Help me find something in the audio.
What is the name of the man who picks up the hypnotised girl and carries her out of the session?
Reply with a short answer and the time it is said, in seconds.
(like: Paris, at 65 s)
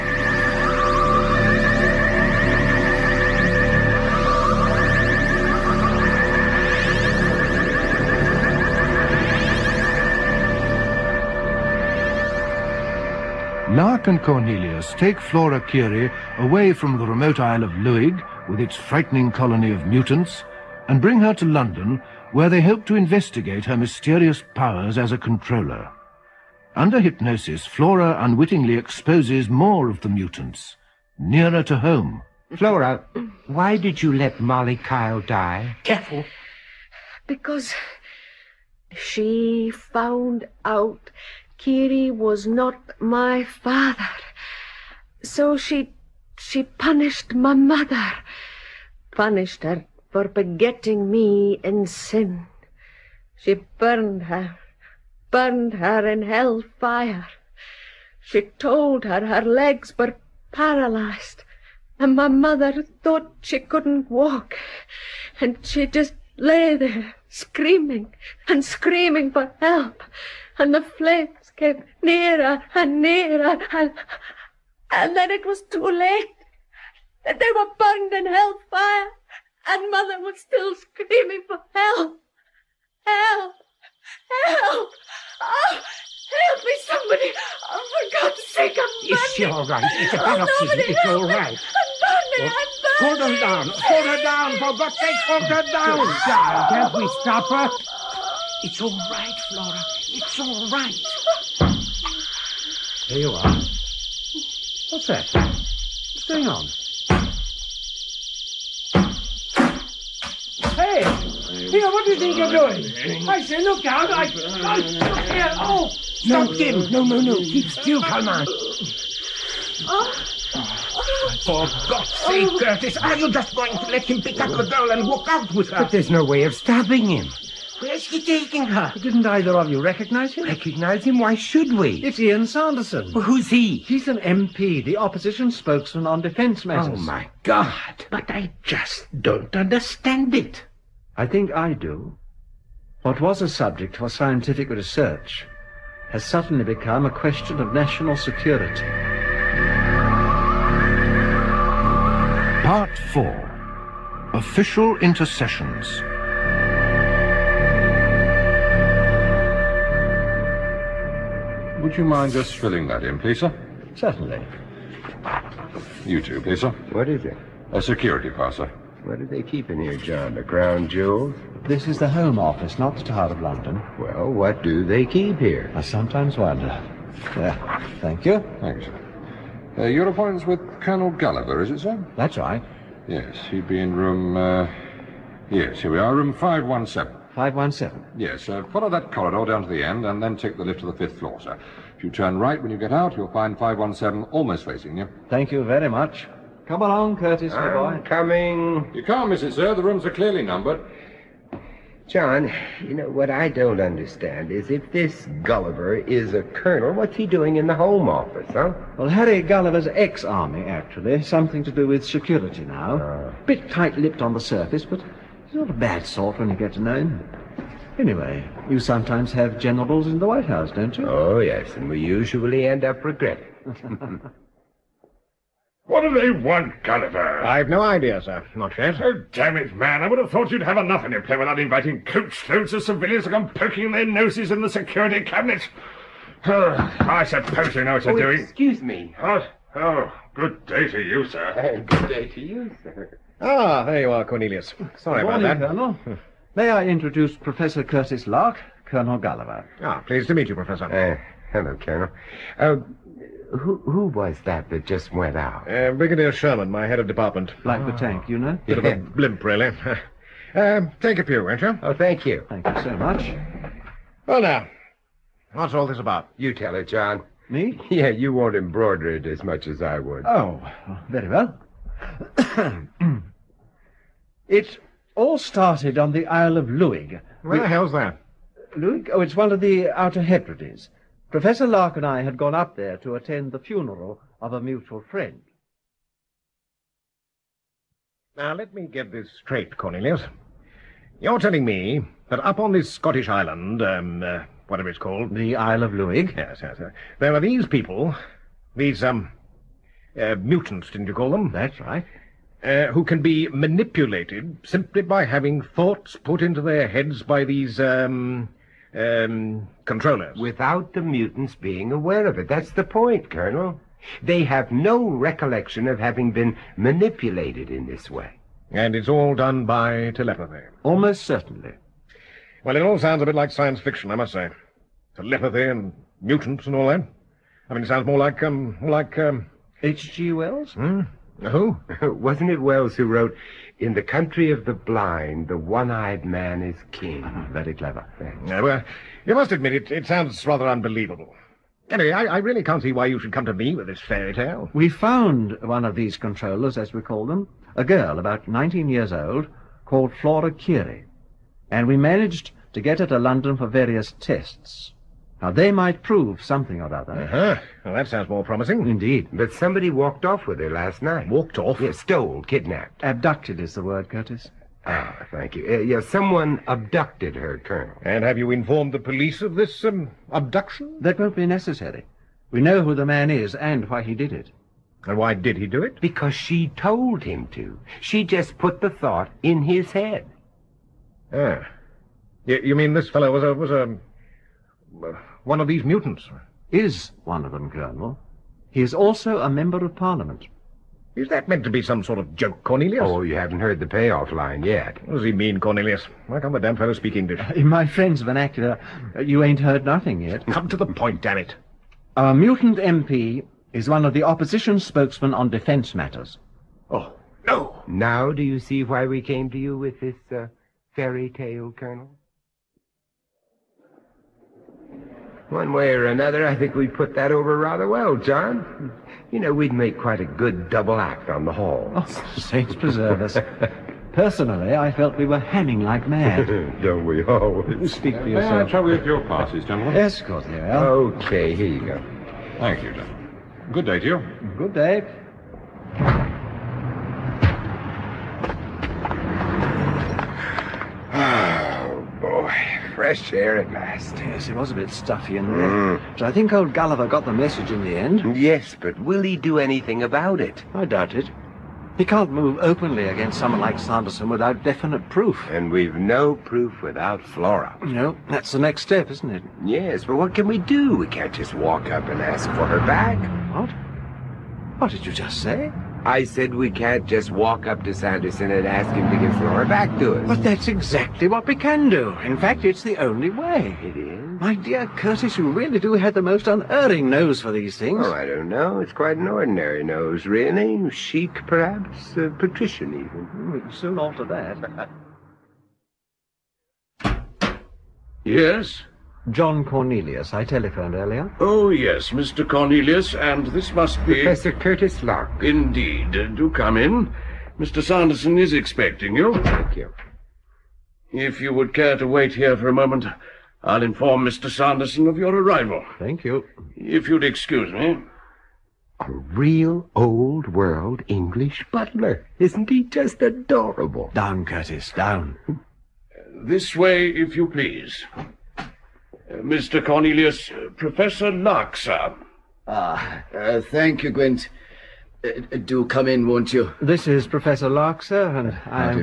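Ian Sanderson, at 132 s.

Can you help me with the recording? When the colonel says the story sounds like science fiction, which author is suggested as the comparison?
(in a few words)
H.G. Wells.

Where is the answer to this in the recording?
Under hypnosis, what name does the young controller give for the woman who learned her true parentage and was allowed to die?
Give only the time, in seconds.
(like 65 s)
34 s.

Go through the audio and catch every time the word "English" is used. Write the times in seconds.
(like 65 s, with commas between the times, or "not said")
397 s, 511 s.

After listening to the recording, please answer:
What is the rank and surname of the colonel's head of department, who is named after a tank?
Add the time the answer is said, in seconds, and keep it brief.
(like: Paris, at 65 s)
Brigadier Sherman, at 255 s.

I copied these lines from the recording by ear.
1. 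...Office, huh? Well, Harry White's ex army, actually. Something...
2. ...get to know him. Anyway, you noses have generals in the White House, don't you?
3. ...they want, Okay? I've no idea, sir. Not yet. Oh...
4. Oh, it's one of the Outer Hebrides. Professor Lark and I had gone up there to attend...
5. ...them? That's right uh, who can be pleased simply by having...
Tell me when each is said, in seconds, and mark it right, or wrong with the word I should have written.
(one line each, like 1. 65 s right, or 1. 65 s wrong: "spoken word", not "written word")
1. 208 s wrong: "Gulliver", not "White"
2. 216 s wrong: "sometimes", not "noses"
3. 226 s wrong: "Gulliver", not "Okay"
4. 279 s right
5. 301 s wrong: "manipulated", not "pleased".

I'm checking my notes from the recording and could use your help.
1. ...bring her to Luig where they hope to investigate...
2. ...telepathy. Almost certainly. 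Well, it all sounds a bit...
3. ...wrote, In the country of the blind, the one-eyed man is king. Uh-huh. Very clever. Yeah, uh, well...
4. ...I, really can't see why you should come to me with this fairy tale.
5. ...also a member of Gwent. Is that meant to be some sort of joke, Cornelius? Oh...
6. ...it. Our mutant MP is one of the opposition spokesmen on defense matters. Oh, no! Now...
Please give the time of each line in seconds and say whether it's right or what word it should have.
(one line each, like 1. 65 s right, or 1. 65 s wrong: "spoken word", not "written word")
1. 20 s wrong: "London", not "Luig"
2. 320 s right
3. 333 s right
4. 342 s right
5. 388 s wrong: "Parliament", not "Gwent"
6. 401 s right.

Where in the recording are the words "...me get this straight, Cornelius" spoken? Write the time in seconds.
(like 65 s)
288 s.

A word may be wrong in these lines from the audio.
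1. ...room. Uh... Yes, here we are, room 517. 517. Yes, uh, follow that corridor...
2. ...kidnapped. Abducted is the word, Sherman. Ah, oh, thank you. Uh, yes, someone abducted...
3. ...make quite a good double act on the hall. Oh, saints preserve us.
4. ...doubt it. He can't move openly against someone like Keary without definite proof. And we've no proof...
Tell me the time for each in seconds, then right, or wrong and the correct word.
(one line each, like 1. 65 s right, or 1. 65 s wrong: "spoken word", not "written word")
1. 183 s right
2. 362 s wrong: "Curtis", not "Sherman"
3. 419 s right
4. 450 s wrong: "Sanderson", not "Keary".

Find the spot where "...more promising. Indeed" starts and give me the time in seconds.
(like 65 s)
358 s.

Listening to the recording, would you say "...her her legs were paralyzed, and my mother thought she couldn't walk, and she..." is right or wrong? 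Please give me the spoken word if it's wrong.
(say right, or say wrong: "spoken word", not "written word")
right.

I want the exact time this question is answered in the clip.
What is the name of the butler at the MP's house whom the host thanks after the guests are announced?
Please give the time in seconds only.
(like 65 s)
524 s.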